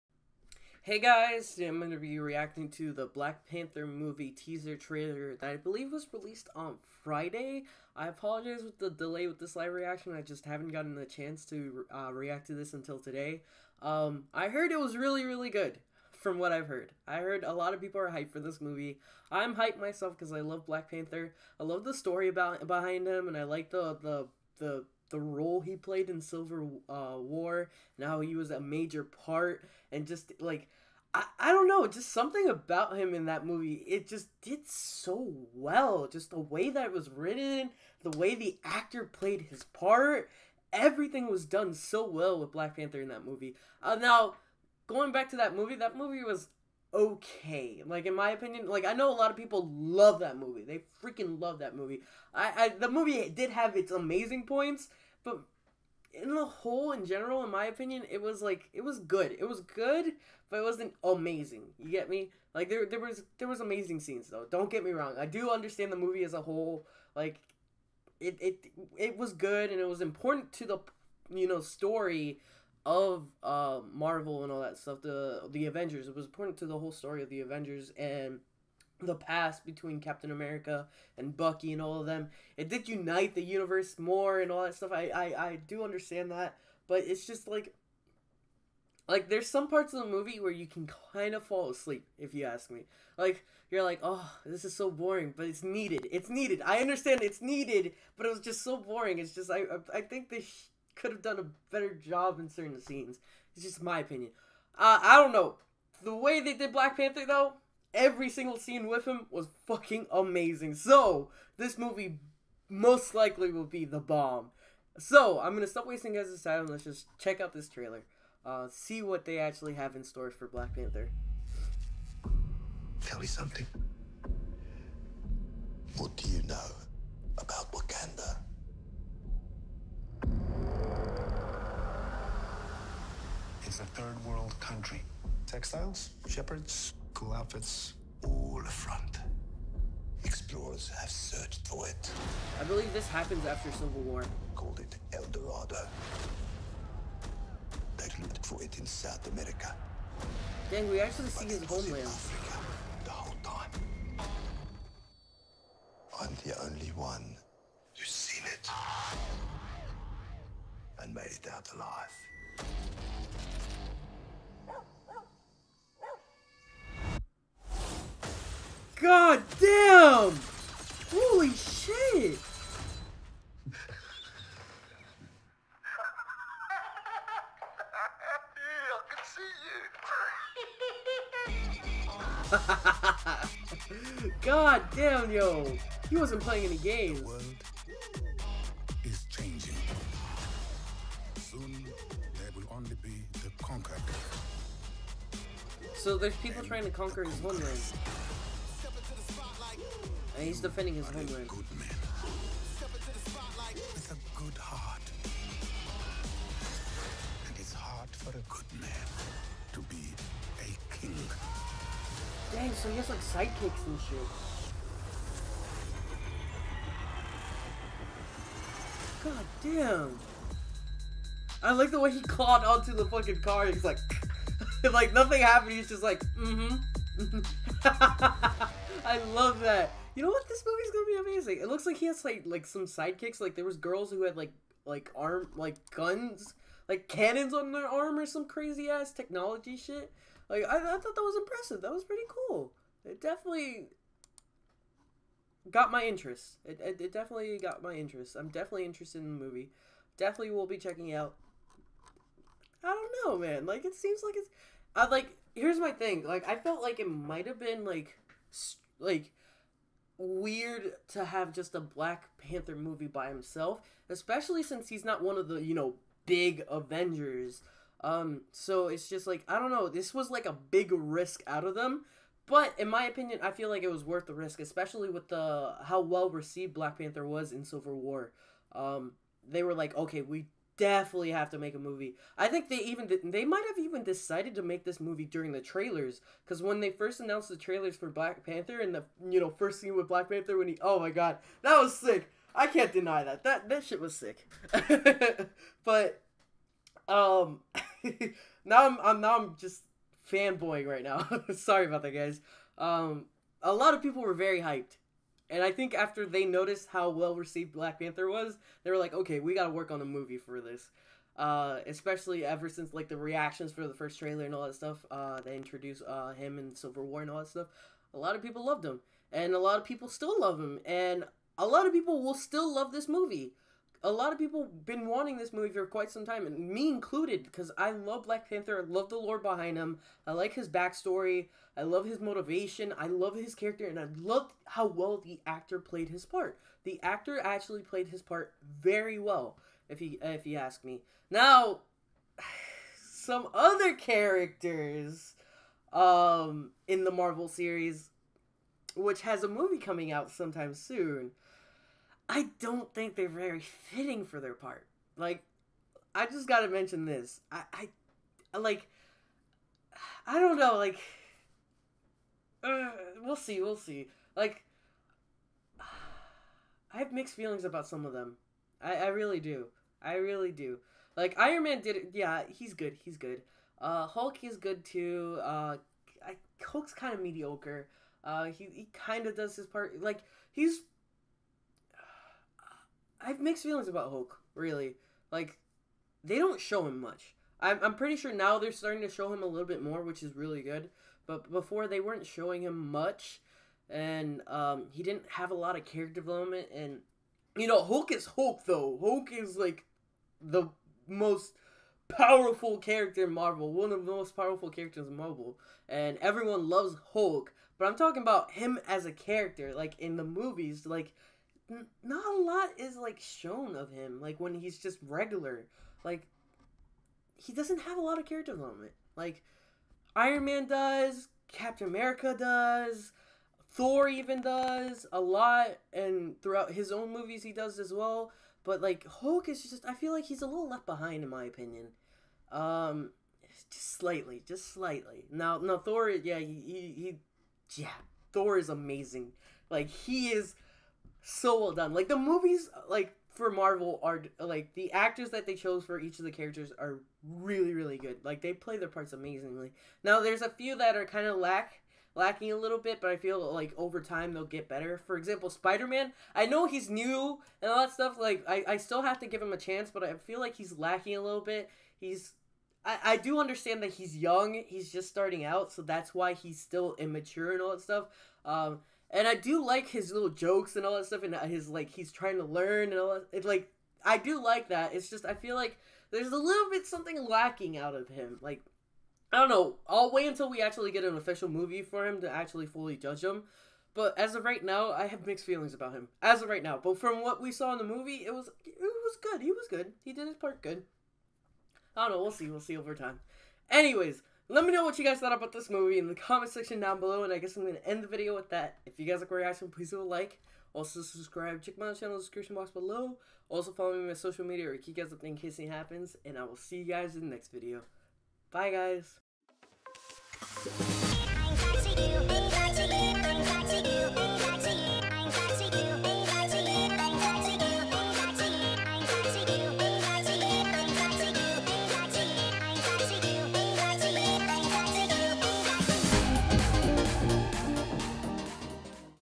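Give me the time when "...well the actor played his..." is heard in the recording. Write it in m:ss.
5:34.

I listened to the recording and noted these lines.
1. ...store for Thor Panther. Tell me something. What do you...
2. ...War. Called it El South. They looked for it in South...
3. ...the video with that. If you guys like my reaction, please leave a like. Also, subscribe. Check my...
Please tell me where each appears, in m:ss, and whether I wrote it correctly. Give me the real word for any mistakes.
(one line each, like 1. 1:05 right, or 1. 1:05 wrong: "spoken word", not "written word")
1. 2:00 wrong: "Black", not "Thor"
2. 2:24 wrong: "Dorado", not "South"
3. 8:18 right.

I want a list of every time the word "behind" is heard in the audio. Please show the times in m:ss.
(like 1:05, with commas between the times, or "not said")
0:22, 5:29, 7:10.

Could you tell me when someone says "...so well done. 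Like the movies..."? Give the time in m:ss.
7:21.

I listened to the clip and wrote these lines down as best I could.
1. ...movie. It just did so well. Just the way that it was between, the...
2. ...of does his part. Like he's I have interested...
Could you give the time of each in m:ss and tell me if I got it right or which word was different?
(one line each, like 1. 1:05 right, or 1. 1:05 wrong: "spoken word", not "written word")
1. 0:33 wrong: "written", not "between"
2. 6:19 wrong: "mixed", not "interested".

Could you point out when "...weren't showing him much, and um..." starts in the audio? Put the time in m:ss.
6:31.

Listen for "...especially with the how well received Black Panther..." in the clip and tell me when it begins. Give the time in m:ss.
4:34.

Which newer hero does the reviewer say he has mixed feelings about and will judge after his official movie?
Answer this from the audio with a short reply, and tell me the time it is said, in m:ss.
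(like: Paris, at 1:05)
Spider Man, at 7:35.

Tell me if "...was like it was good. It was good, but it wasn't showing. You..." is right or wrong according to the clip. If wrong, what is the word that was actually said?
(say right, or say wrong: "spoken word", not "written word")
wrong: "amazing", not "showing".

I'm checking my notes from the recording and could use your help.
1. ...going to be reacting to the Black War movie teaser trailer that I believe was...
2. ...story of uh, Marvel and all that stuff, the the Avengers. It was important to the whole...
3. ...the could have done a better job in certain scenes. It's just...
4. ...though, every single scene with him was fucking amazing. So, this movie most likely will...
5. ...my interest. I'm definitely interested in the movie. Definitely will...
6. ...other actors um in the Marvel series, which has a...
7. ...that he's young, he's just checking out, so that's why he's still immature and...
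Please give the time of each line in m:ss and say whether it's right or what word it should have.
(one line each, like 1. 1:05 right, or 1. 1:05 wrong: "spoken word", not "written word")
1. 0:01 wrong: "Panther", not "War"
2. 1:11 right
3. 1:40 right
4. 1:47 right
5. 4:07 right
6. 5:43 wrong: "characters", not "actors"
7. 7:43 wrong: "starting", not "checking".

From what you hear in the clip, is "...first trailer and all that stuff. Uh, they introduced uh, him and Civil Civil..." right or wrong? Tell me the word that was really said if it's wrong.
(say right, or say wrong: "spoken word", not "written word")
wrong: "War", not "Civil".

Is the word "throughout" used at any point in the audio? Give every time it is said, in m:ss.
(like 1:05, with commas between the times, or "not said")
7:06.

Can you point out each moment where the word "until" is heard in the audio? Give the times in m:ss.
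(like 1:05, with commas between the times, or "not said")
0:12, 8:00.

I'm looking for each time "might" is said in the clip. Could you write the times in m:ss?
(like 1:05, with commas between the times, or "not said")
4:17, 4:43.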